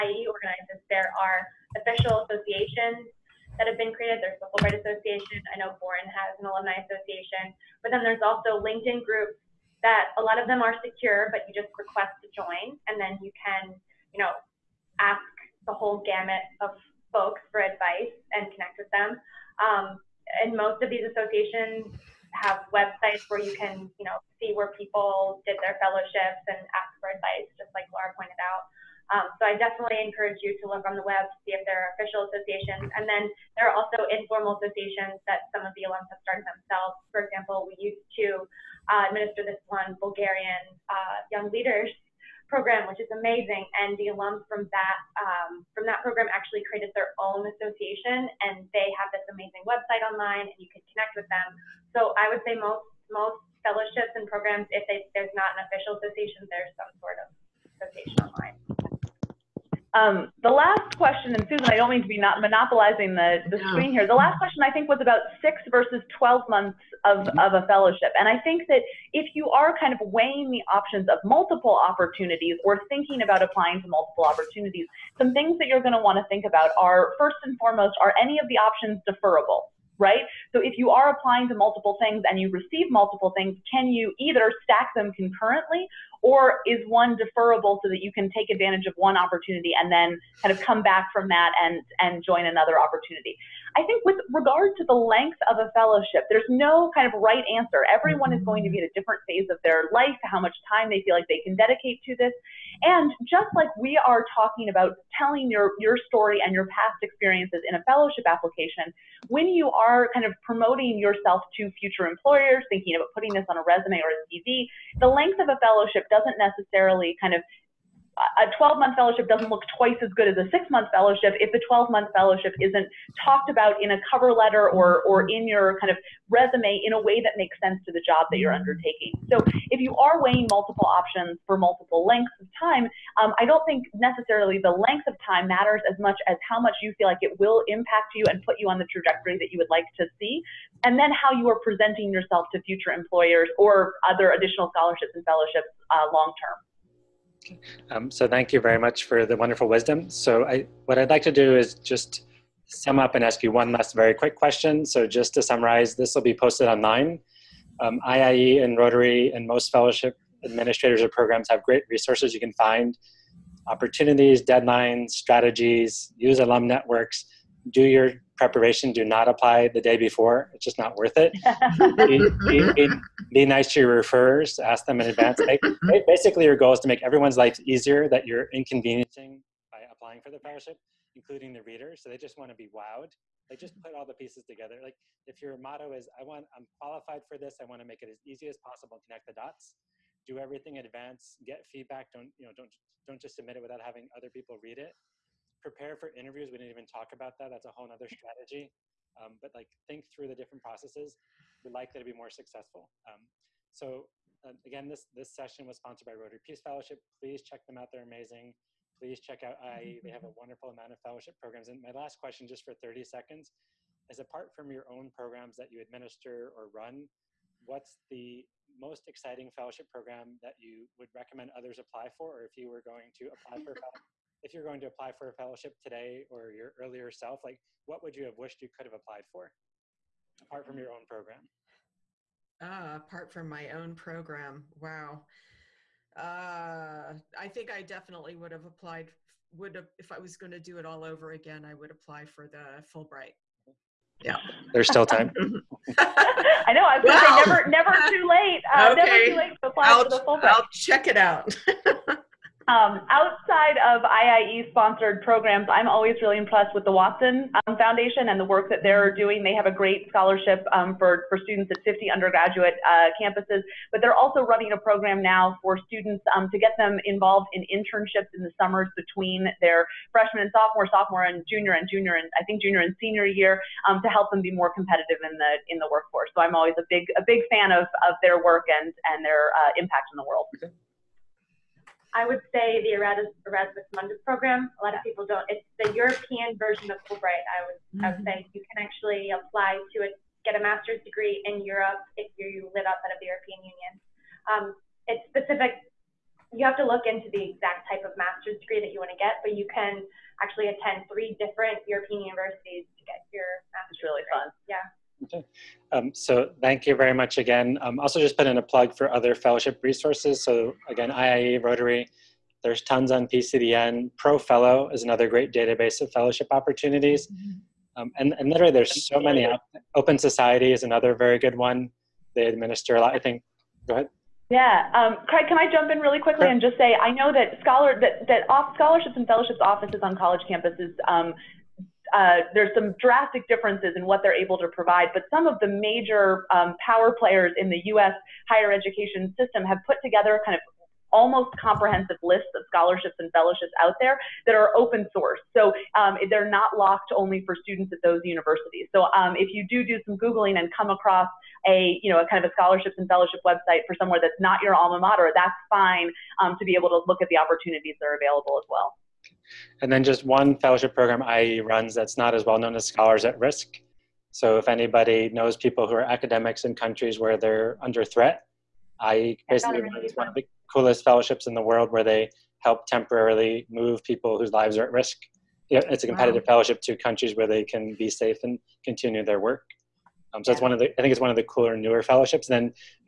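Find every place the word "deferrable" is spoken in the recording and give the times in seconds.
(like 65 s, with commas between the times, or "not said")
79 s, 87 s.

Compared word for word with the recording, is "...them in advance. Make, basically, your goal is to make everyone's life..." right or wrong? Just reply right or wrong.
right.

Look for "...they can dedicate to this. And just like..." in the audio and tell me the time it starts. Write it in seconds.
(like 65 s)
101 s.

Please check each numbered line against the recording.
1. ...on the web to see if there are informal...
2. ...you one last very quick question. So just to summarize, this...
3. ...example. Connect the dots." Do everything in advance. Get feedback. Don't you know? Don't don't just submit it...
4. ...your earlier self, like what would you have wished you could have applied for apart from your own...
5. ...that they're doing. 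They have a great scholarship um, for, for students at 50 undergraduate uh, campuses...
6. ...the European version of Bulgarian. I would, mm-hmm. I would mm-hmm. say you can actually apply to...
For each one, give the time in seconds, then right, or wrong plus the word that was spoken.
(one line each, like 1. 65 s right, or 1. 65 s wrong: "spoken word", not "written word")
1. 30 s wrong: "official", not "informal"
2. 153 s right
3. 188 s wrong: "possible", not "example"
4. 226 s right
5. 258 s right
6. 285 s wrong: "Fulbright", not "Bulgarian".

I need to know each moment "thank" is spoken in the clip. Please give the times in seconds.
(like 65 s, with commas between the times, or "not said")
148 s, 306 s.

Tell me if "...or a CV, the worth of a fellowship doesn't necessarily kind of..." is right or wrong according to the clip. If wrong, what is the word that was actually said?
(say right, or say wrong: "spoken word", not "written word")
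wrong: "length", not "worth".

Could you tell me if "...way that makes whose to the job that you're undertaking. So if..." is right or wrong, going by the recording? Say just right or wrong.
wrong.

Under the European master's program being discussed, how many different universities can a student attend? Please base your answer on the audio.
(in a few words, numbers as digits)
3.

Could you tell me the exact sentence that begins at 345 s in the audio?
So um, they're not locked only for students at those universities.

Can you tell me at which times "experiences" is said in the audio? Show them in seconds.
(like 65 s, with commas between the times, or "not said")
107 s.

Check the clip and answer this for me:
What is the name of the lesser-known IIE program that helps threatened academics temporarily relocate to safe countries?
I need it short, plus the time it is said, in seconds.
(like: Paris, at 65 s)
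Scholars at Risk, at 362 s.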